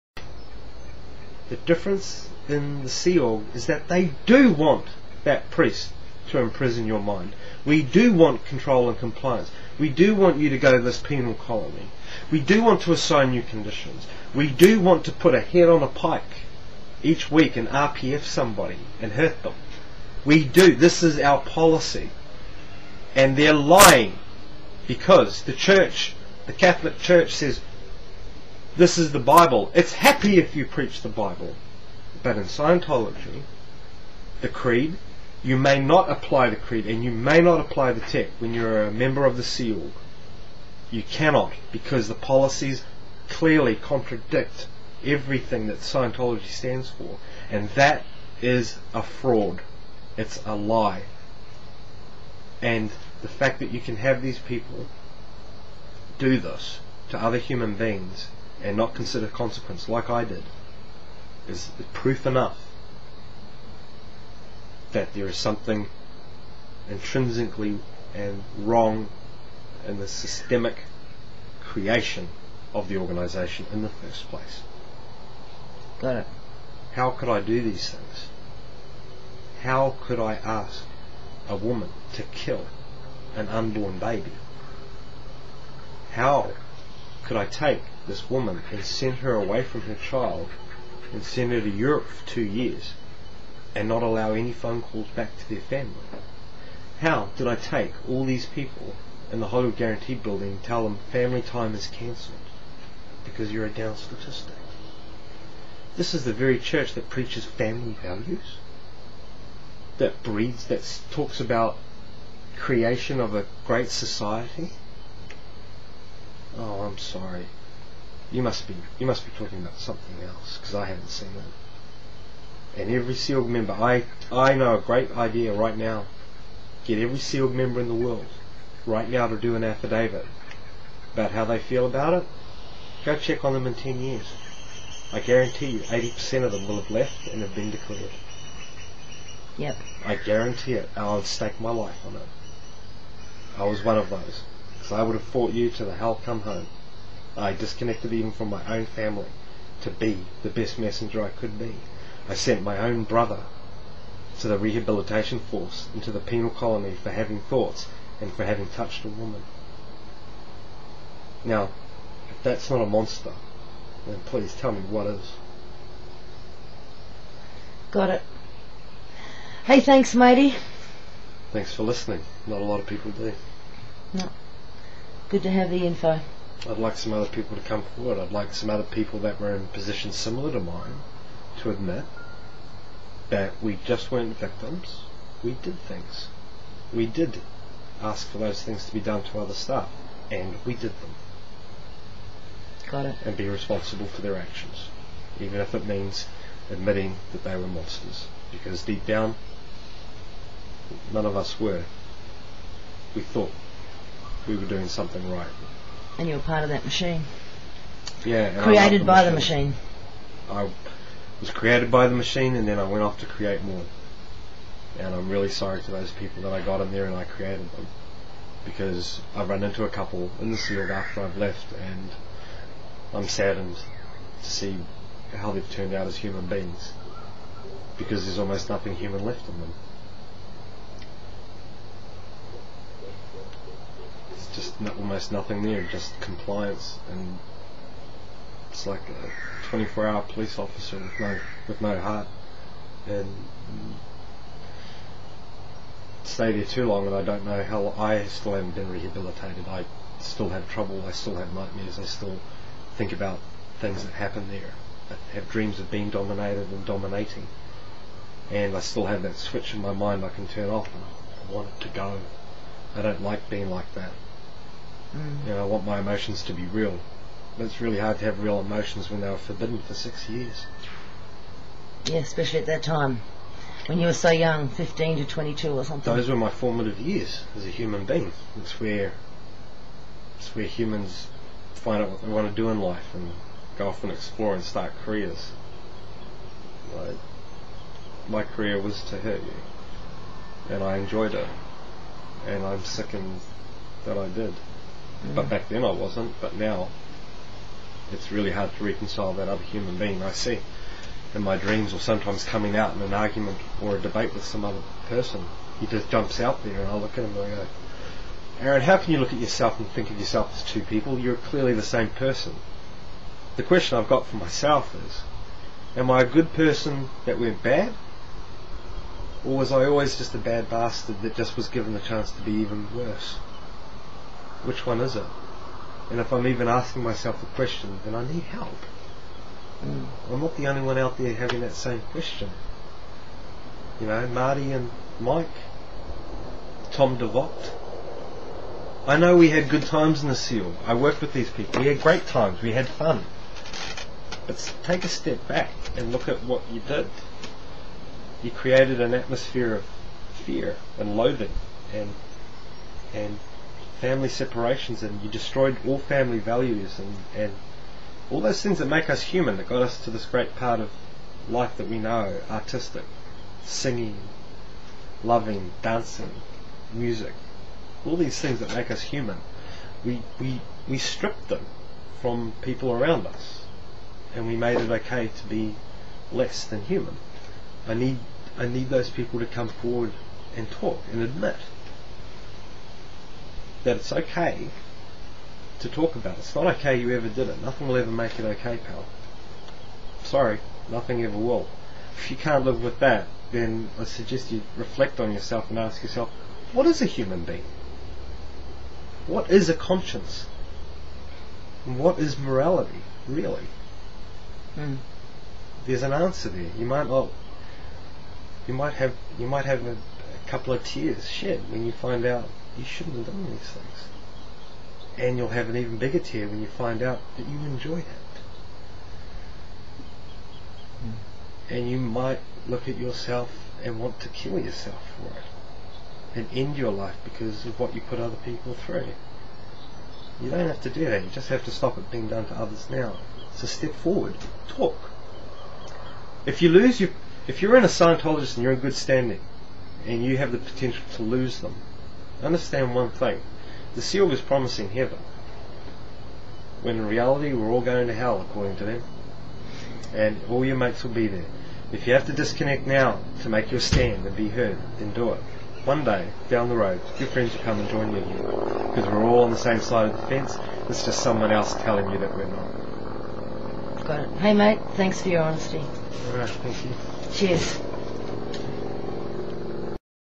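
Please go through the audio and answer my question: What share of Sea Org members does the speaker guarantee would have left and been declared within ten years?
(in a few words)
80 percent.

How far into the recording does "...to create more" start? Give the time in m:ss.
3:33.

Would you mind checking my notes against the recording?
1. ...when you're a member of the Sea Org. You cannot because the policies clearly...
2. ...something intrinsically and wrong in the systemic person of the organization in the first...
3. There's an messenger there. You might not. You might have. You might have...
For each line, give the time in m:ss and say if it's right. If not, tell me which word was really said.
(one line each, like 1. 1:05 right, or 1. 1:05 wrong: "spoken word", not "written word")
1. 0:38 right
2. 1:05 wrong: "creation", not "person"
3. 6:45 wrong: "answer", not "messenger".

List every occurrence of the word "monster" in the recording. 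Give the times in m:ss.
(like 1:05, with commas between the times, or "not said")
2:42, 3:17.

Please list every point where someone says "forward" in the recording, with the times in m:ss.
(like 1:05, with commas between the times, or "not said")
2:57, 6:19, 7:13.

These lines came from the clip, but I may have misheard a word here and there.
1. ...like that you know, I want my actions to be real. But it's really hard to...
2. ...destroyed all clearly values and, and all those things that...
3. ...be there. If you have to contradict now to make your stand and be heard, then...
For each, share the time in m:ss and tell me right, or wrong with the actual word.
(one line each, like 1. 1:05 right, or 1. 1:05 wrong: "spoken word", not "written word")
1. 4:23 wrong: "emotions", not "actions"
2. 5:55 wrong: "family", not "clearly"
3. 7:31 wrong: "disconnect", not "contradict".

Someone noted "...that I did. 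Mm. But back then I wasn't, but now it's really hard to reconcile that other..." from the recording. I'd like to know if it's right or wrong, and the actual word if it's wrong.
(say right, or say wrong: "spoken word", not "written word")
right.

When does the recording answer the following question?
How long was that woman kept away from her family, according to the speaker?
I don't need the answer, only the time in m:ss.
1:32.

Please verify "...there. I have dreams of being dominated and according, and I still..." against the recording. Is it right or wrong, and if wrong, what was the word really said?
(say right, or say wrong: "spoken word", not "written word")
wrong: "dominating", not "according".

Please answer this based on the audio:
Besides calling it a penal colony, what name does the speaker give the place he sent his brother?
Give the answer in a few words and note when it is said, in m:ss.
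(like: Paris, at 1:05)
Rehabilitation Force, at 2:34.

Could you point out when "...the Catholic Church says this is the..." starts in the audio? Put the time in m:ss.
0:26.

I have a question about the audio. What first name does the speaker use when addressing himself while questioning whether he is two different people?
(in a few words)
Aaron.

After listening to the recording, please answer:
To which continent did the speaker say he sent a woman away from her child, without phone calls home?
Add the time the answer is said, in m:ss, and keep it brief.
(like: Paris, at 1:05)
Europe, at 1:31.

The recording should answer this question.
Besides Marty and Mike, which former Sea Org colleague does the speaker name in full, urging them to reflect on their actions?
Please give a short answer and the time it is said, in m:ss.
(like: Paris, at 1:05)
Tom DeVocht, at 5:36.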